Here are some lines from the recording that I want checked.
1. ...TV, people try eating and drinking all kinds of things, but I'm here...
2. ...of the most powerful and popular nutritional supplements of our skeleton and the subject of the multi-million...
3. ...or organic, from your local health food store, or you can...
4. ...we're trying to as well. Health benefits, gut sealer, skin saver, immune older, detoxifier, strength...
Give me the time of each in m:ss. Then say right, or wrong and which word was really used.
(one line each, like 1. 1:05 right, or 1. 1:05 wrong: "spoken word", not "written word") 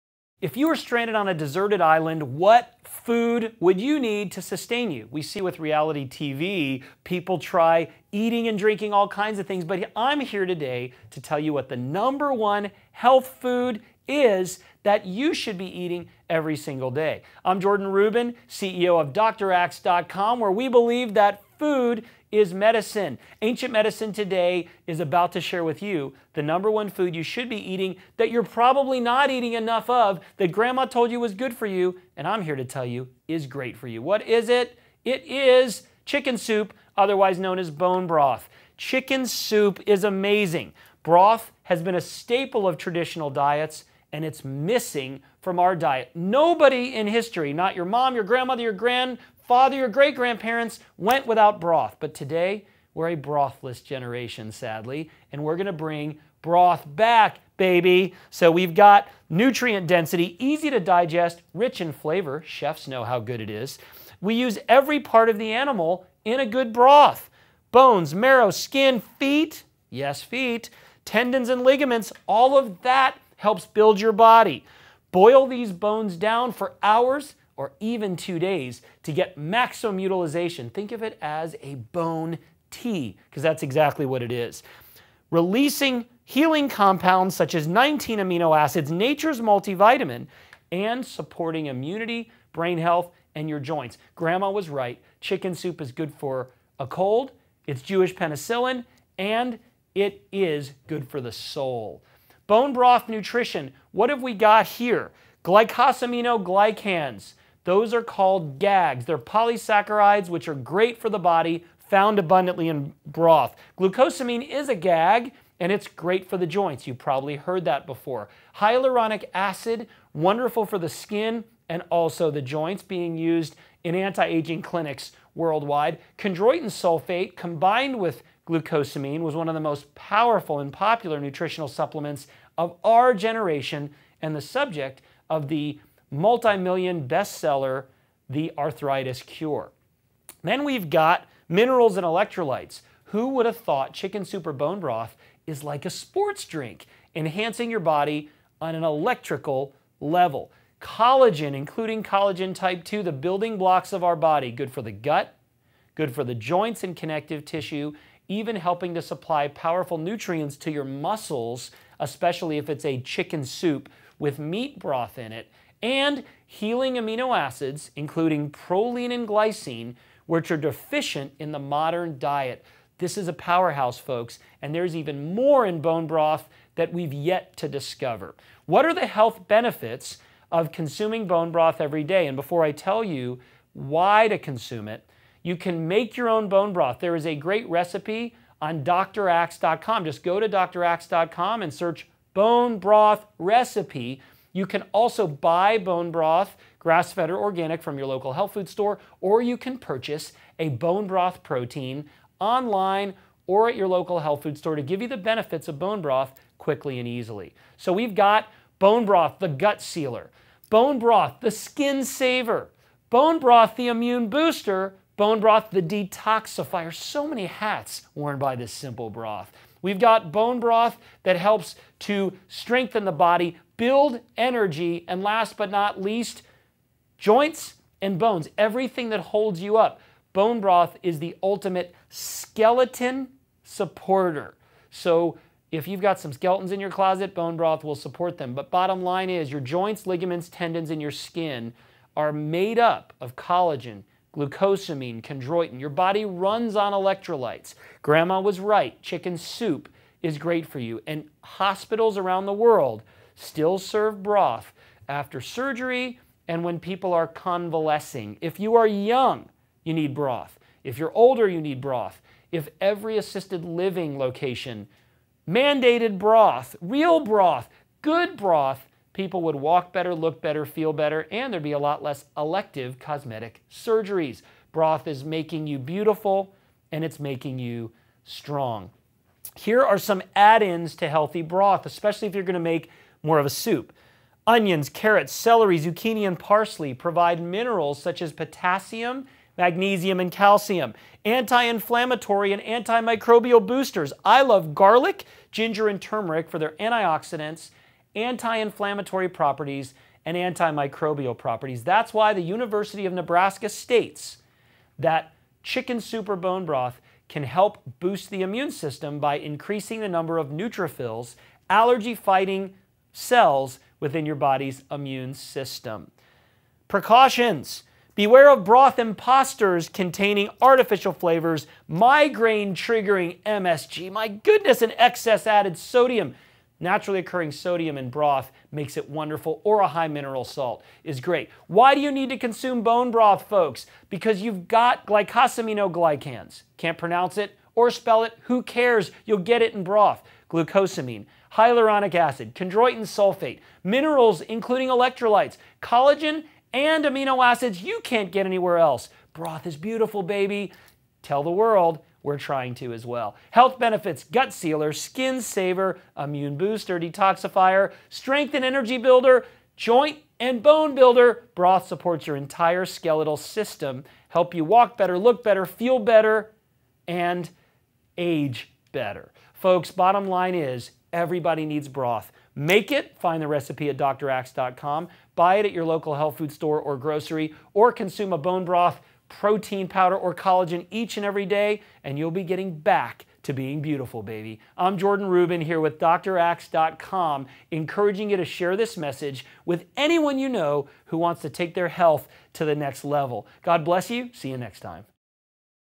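1. 0:06 right
2. 2:09 wrong: "generation", not "skeleton"
3. 3:17 right
4. 5:52 wrong: "booster", not "older".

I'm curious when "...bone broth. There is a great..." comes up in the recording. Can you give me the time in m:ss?
3:06.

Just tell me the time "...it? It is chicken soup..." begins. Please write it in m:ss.
0:34.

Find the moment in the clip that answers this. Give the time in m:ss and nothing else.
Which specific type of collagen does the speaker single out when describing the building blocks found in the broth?
2:32.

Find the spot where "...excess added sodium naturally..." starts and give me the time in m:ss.
5:24.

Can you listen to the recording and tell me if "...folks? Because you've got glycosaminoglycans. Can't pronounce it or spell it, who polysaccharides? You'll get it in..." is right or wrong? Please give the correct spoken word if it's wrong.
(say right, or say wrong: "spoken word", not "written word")
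wrong: "cares", not "polysaccharides".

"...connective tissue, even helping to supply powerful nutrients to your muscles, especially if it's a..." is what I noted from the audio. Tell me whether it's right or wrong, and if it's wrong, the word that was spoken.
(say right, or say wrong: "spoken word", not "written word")
right.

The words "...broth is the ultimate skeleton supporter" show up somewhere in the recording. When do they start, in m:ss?
3:50.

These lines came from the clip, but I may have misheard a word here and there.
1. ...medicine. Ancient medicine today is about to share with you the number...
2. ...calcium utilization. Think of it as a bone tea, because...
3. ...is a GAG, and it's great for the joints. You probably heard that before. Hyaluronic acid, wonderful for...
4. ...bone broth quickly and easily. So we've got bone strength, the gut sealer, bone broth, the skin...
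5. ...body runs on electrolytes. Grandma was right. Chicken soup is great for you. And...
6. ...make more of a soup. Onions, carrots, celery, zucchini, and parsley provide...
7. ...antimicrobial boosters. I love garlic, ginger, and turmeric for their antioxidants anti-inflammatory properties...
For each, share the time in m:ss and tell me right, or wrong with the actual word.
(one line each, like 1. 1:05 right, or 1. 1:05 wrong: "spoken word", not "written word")
1. 0:22 right
2. 1:19 wrong: "maximum", not "calcium"
3. 1:54 right
4. 3:25 wrong: "broth", not "strength"
5. 4:05 right
6. 4:42 right
7. 4:52 right.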